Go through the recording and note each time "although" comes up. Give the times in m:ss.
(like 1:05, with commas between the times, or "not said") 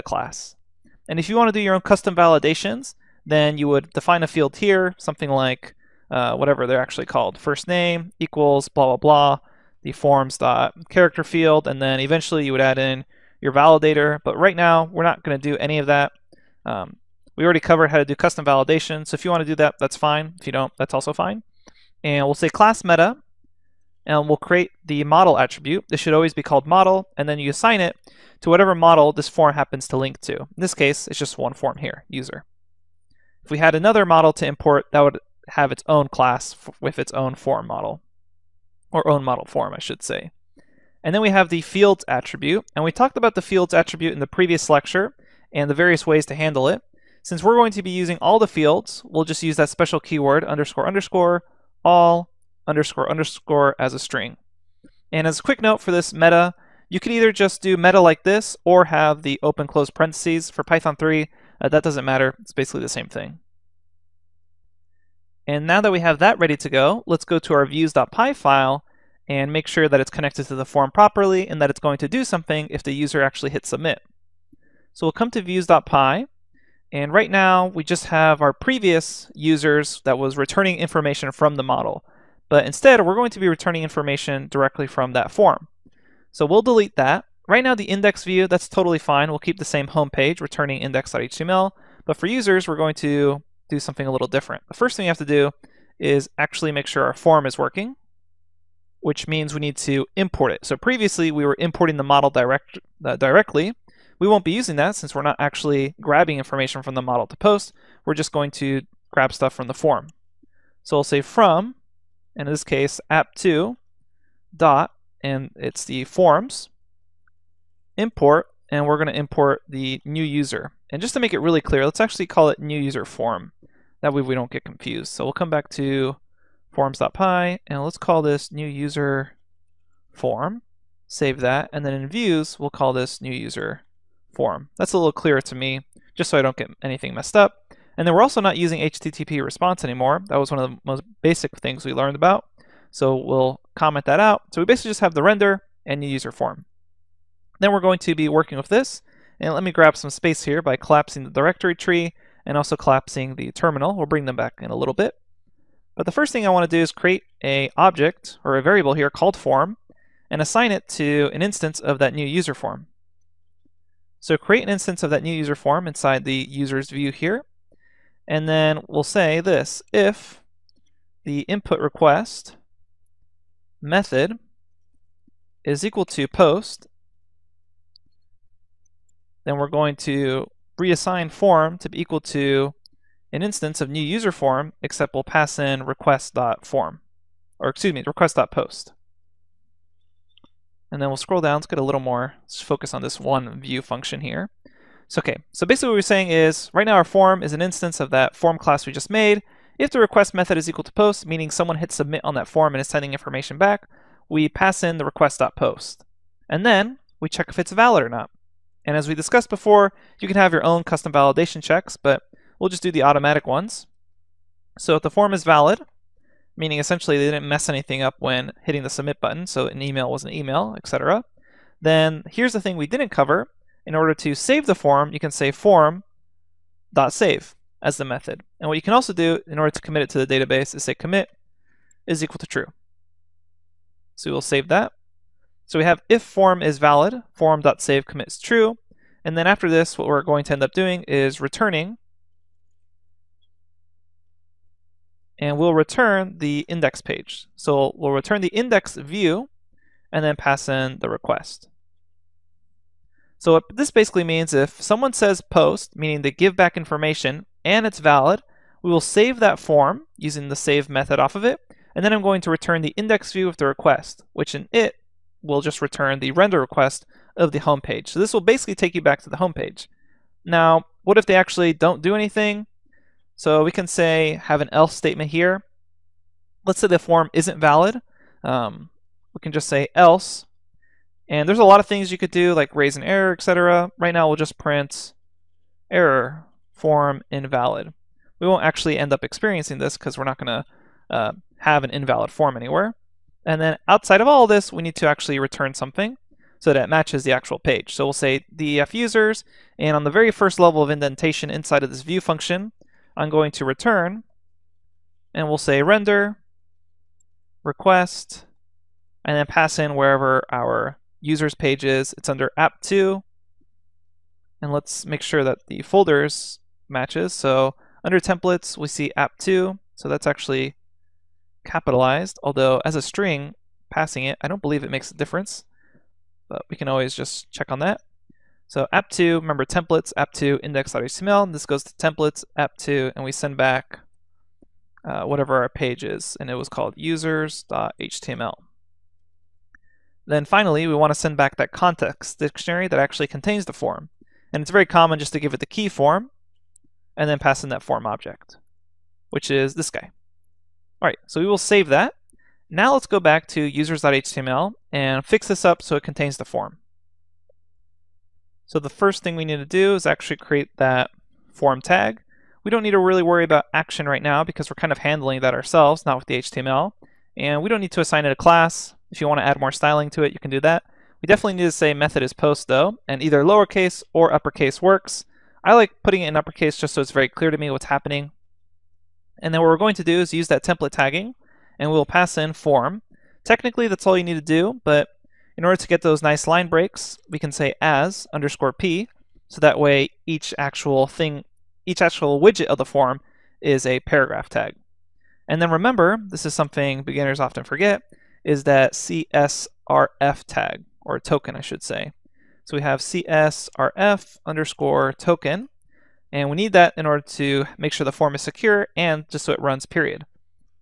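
5:22.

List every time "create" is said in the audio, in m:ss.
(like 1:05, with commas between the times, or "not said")
0:24, 2:36, 2:44, 6:00.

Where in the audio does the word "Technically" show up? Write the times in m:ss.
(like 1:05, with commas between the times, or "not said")
6:23.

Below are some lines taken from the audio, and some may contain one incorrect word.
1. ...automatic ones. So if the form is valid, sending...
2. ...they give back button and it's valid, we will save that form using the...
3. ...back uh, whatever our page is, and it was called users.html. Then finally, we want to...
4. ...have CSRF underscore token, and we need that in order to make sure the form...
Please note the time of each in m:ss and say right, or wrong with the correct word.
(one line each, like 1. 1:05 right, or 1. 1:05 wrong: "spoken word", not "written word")
1. 3:33 wrong: "meaning", not "sending"
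2. 4:16 wrong: "information", not "button"
3. 5:33 right
4. 6:42 right.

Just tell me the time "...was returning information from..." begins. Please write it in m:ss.
1:20.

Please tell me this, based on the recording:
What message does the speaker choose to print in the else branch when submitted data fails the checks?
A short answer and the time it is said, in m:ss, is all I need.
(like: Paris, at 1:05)
error form invalid, at 4:45.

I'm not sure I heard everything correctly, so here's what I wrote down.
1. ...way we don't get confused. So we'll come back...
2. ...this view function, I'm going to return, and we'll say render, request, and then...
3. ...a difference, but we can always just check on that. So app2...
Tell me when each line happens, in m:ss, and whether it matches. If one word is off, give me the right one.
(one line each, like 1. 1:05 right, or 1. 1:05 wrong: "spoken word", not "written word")
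1. 2:04 right
2. 5:01 right
3. 5:25 right.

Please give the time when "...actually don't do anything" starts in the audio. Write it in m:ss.
4:31.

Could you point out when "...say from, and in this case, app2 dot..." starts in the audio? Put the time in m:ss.
1:51.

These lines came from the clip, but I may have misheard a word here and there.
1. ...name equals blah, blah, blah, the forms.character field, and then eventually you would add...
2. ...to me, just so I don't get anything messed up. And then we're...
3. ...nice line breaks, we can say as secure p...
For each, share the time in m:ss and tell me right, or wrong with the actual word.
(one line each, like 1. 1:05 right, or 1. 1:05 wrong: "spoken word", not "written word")
1. 0:07 right
2. 2:15 right
3. 6:26 wrong: "underscore", not "secure".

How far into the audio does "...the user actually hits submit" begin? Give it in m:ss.
1:12.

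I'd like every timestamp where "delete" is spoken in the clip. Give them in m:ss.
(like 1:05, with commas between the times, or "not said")
1:26.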